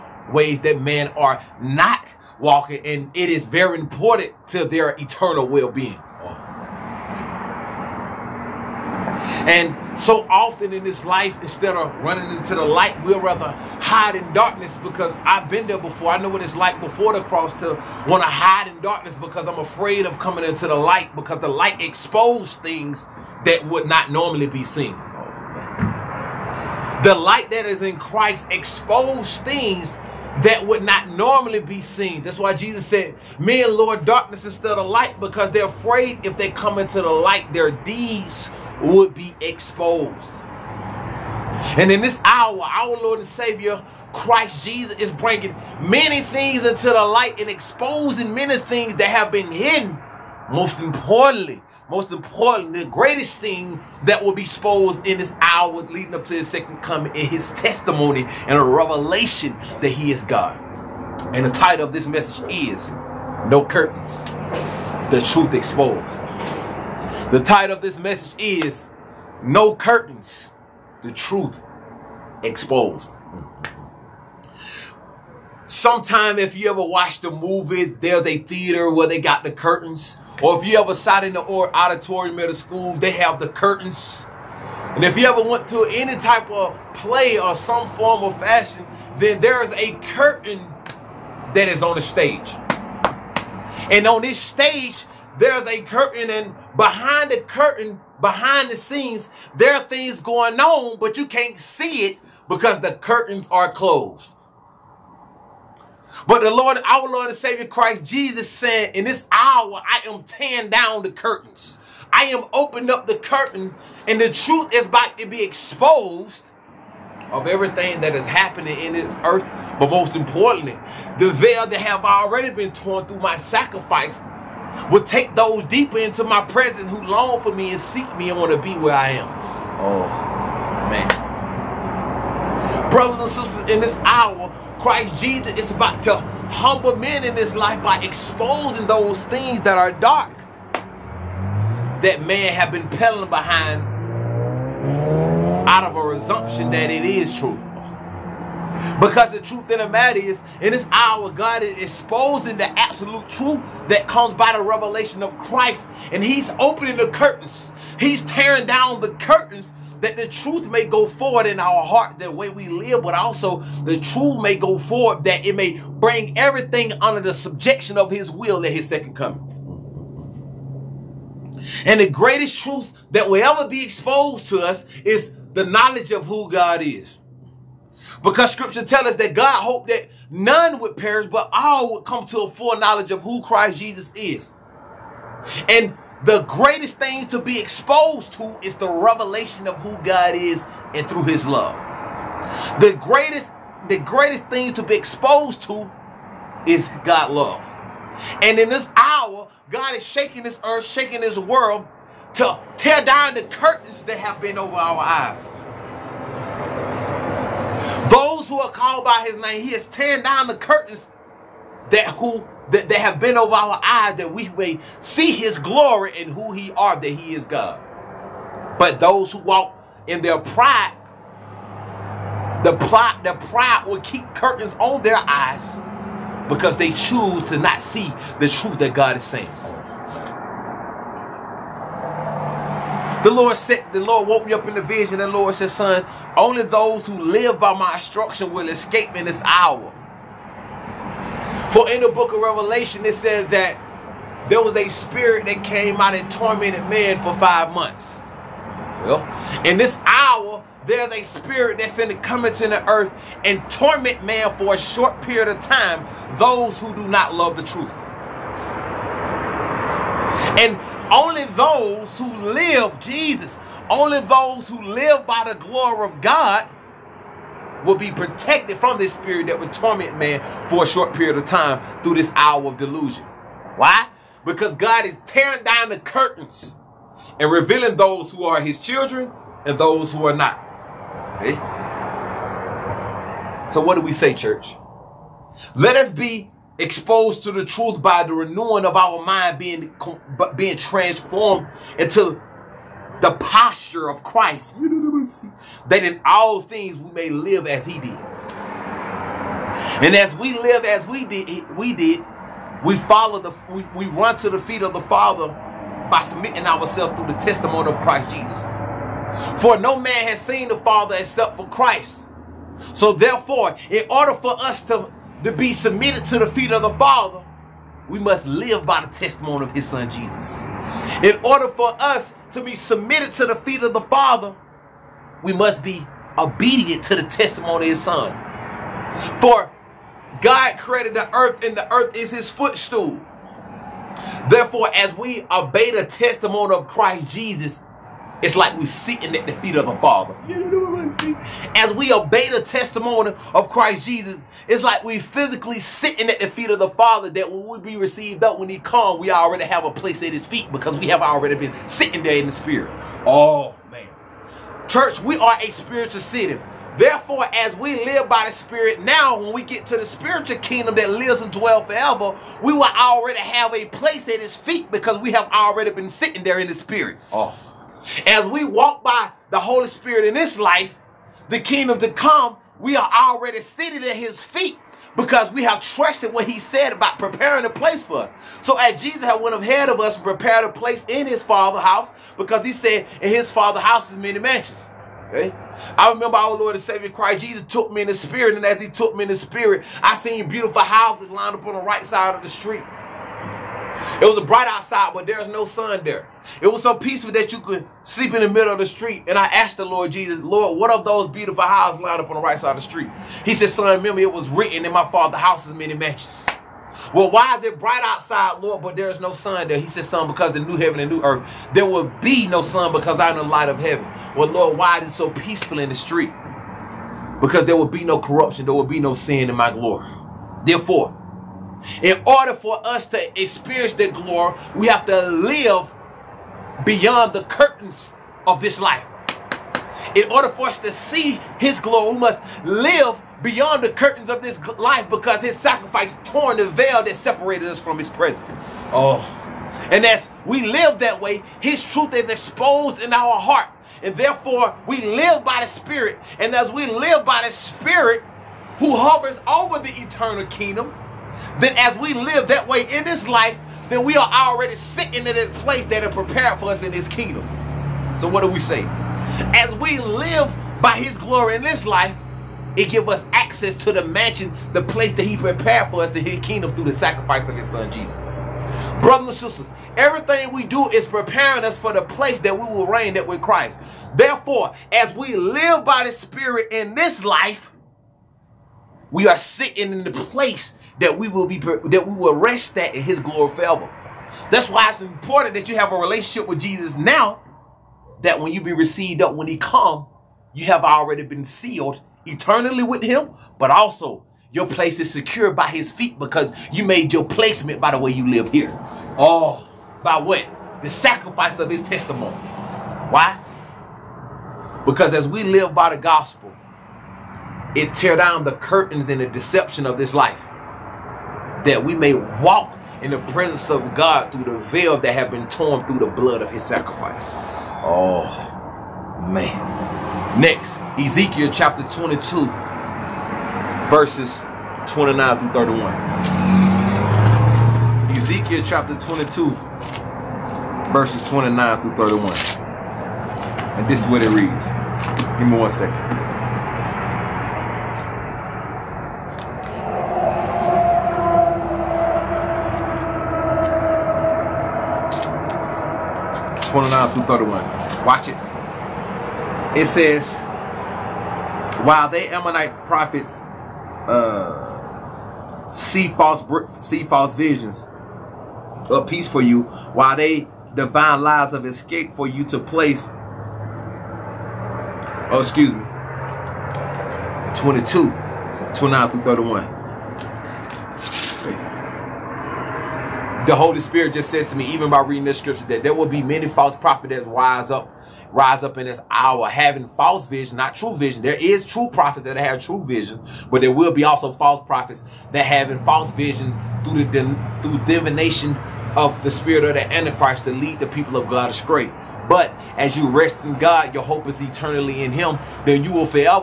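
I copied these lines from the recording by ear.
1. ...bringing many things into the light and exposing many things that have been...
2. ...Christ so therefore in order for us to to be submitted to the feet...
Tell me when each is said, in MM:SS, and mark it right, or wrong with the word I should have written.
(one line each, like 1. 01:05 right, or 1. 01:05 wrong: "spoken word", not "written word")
1. 00:45 right
2. 05:11 right.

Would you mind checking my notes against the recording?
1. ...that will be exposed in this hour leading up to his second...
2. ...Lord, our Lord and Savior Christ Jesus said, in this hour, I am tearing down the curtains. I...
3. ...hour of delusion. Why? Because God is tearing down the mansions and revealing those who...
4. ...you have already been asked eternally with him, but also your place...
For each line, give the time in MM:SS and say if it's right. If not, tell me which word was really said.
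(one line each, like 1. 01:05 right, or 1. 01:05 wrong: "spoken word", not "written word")
1. 00:54 right
2. 01:46 right
3. 04:32 wrong: "curtains", not "mansions"
4. 08:10 wrong: "sealed", not "asked".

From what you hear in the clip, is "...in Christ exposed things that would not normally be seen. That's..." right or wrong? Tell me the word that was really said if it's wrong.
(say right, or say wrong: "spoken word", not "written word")
right.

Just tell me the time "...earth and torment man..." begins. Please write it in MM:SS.
04:12.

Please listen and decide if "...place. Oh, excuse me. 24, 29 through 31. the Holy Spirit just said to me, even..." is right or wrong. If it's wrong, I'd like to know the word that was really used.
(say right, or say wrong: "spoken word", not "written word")
wrong: "22", not "24".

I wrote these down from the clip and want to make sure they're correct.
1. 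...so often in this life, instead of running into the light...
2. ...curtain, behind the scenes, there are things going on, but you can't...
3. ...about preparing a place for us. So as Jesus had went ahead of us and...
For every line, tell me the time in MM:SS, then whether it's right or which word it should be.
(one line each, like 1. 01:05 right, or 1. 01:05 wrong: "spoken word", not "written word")
1. 00:09 right
2. 01:37 right
3. 06:16 right.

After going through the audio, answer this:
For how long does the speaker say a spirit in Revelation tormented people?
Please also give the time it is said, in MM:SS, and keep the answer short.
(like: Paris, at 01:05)
5 months, at 04:07.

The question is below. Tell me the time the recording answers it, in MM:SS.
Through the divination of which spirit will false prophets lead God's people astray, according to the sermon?
09:49.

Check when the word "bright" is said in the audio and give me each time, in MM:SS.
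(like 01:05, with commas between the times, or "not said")
06:34, 06:47.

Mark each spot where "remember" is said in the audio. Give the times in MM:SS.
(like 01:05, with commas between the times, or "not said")
06:26, 06:43.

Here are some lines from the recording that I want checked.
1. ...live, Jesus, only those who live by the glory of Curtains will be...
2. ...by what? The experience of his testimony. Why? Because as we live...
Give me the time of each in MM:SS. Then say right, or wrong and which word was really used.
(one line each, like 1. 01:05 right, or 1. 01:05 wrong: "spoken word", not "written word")
1. 04:22 wrong: "God", not "Curtains"
2. 08:20 wrong: "sacrifice", not "experience".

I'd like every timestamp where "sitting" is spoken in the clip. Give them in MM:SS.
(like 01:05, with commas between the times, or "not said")
05:38, 05:45, 05:51, 06:06, 07:34, 07:59.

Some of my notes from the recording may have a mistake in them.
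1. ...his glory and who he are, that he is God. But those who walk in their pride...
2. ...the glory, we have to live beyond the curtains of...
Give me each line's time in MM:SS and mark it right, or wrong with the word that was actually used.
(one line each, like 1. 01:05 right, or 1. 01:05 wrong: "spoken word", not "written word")
1. 03:35 right
2. 07:03 right.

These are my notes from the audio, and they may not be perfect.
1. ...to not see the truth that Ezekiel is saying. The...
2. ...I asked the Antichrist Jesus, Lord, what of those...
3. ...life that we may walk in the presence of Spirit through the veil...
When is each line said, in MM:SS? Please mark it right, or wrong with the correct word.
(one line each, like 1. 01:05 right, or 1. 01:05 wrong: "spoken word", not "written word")
1. 03:47 wrong: "God", not "Ezekiel"
2. 06:39 wrong: "Lord", not "Antichrist"
3. 08:30 wrong: "God", not "Spirit".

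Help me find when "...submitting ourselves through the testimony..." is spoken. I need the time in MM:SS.
05:06.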